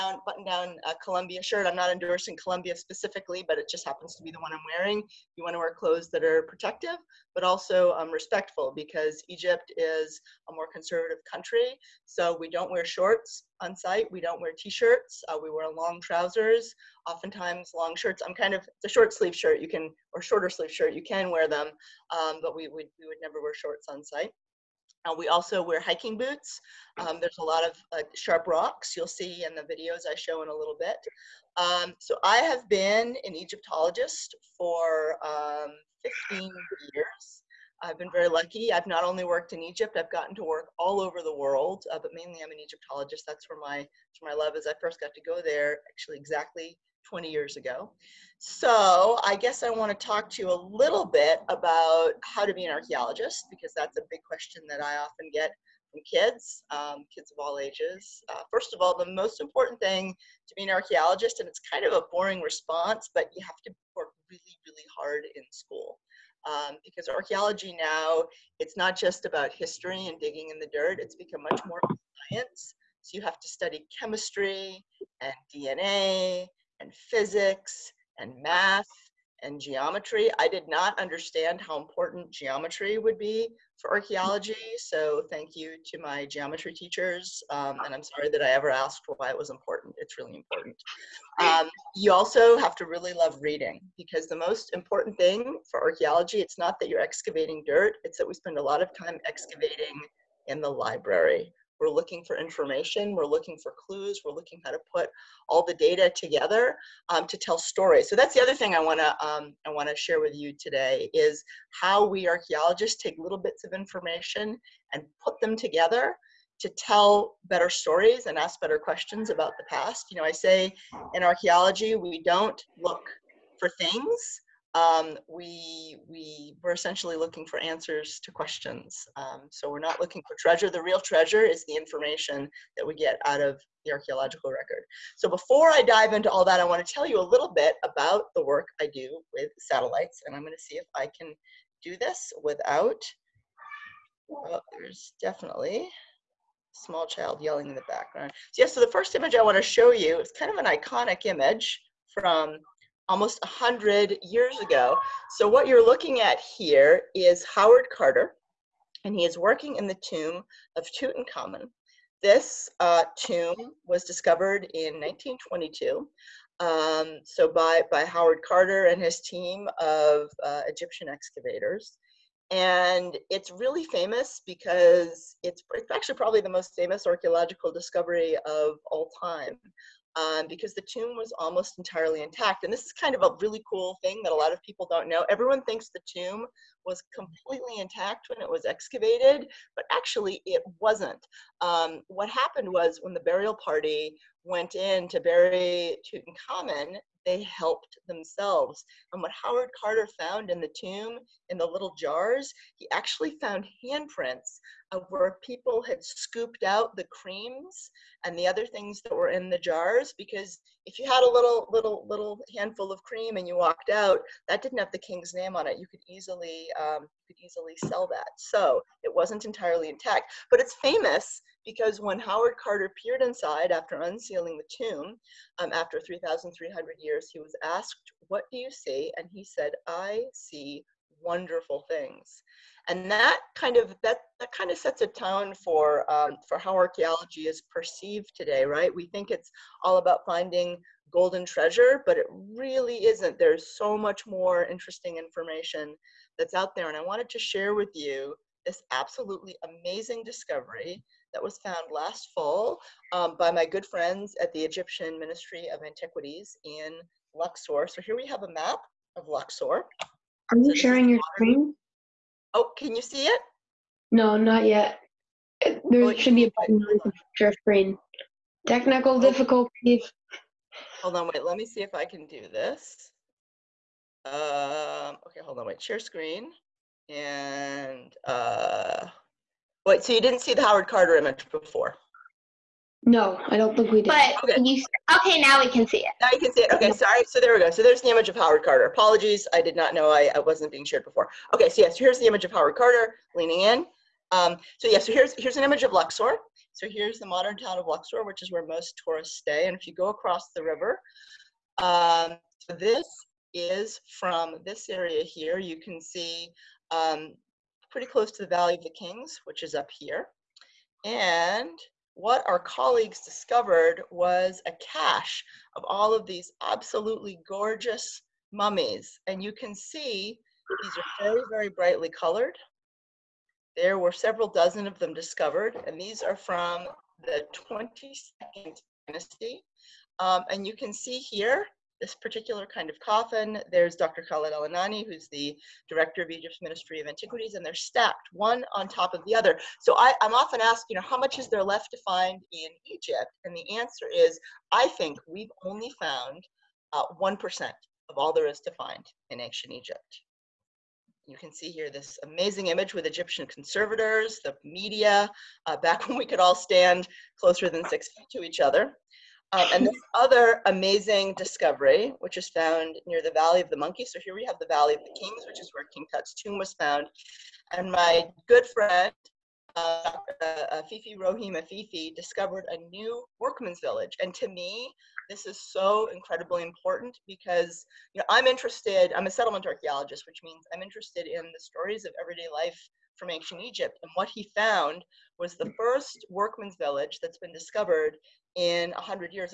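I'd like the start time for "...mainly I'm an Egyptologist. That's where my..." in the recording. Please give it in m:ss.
0:42.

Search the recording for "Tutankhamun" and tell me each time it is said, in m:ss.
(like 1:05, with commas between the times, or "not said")
2:40, 3:16.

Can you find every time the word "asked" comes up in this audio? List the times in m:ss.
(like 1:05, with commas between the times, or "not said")
1:28, 3:47, 5:40.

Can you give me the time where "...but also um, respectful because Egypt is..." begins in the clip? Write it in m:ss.
0:07.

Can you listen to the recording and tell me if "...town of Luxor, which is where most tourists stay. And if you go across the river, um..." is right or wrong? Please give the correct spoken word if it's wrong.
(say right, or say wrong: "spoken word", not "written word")
right.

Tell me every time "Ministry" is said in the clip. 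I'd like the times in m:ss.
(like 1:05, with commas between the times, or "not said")
4:15, 5:36.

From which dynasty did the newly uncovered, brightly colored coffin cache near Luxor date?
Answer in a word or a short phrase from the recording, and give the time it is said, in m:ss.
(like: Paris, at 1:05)
22nd dynasty, at 5:27.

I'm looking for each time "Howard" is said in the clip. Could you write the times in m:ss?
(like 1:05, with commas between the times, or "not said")
2:37, 2:48, 3:19, 3:42, 4:40, 4:48, 4:52.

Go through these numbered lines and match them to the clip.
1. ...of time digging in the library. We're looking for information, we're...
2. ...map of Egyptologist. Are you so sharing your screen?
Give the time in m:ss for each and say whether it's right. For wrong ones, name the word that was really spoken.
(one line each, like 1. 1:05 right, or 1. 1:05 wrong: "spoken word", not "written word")
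1. 1:38 wrong: "excavating", not "digging"
2. 4:18 wrong: "Luxor", not "Egyptologist".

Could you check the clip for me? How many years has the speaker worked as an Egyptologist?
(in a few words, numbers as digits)
15 years.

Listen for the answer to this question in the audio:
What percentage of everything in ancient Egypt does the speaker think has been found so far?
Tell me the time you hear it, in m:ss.
5:47.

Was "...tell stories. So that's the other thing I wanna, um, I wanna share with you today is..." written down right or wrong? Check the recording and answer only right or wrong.
right.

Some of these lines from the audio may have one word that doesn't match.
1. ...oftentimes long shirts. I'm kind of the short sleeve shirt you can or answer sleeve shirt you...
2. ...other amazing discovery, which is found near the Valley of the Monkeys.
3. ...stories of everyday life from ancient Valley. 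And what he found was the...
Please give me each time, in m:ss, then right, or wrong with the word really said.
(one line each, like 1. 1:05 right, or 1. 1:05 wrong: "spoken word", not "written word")
1. 0:17 wrong: "shorter", not "answer"
2. 6:00 right
3. 6:21 wrong: "Egypt", not "Valley".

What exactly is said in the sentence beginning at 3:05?
Everyone thinks the tomb was completely intact when it was excavated, but actually it wasn't.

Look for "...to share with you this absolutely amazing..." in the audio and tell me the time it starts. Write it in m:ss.
4:07.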